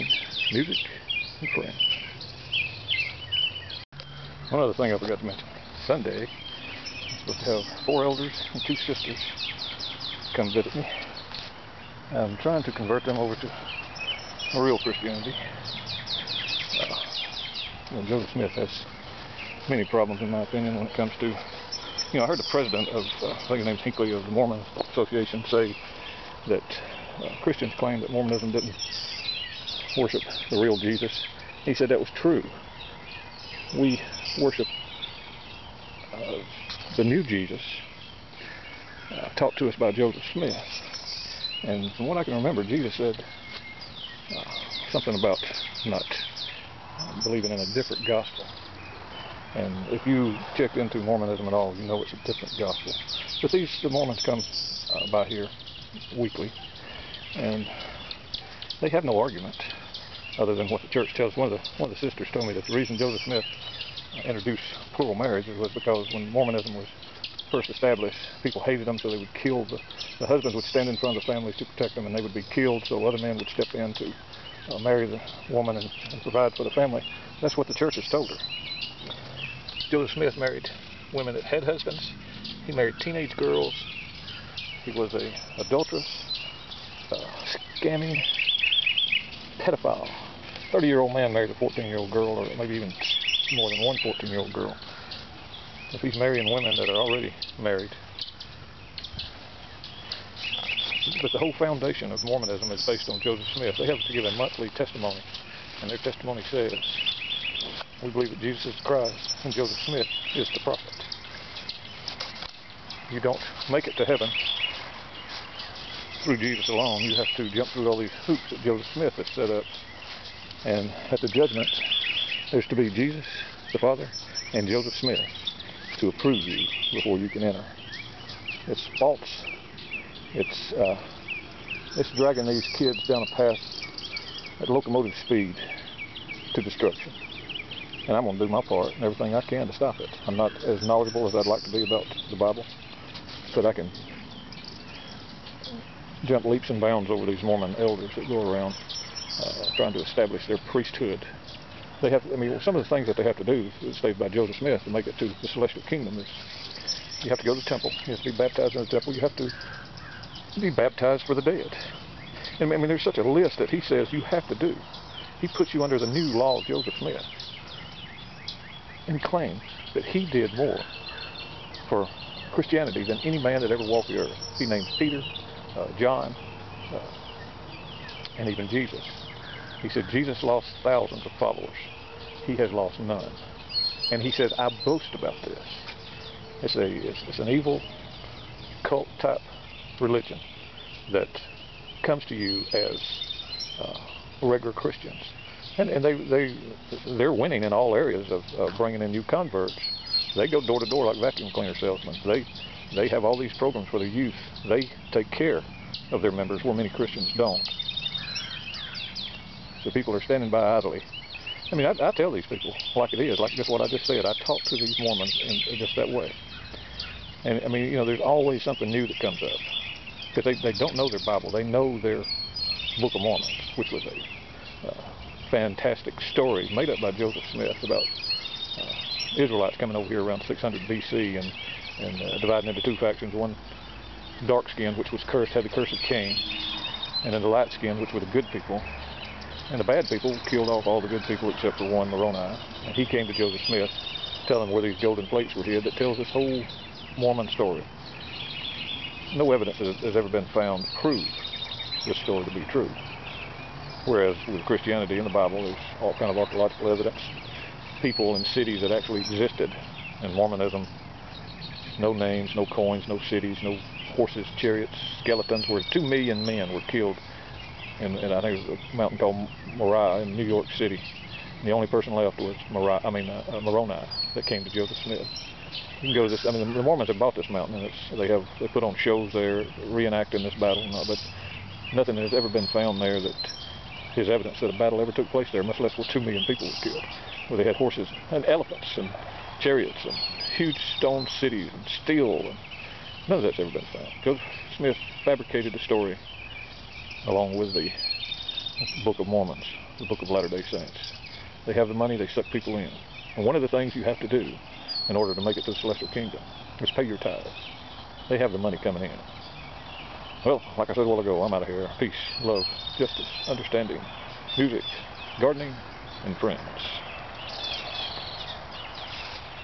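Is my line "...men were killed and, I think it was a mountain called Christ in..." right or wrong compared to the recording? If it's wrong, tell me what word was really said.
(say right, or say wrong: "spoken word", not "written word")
wrong: "Moriah", not "Christ".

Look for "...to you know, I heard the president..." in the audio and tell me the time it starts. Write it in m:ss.
0:21.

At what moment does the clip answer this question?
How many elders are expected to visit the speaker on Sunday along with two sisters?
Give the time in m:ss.
0:07.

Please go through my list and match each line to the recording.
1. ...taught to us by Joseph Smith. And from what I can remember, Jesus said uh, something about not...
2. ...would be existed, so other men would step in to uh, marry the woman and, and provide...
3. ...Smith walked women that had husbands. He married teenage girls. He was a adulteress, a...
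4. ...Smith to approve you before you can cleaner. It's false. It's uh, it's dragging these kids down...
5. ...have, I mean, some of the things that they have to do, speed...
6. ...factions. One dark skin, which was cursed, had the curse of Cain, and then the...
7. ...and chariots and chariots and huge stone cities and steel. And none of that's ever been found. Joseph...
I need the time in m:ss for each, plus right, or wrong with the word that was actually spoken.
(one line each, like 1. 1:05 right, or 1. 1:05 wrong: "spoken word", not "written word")
1. 0:39 right
2. 1:12 wrong: "killed", not "existed"
3. 1:20 wrong: "married", not "walked"
4. 2:04 wrong: "enter", not "cleaner"
5. 2:32 wrong: "stated", not "speed"
6. 3:53 right
7. 4:48 wrong: "elephants", not "chariots".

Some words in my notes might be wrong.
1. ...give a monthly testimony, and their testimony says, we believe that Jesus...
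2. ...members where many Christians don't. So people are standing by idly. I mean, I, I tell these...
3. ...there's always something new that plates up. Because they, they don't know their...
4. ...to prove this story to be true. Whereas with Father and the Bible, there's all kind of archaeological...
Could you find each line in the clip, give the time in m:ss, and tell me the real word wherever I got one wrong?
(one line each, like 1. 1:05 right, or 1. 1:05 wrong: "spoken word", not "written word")
1. 1:44 right
2. 3:26 right
3. 3:38 wrong: "comes", not "plates"
4. 4:10 wrong: "Christianity", not "Father".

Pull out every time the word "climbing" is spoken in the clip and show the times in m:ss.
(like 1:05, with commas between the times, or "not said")
not said.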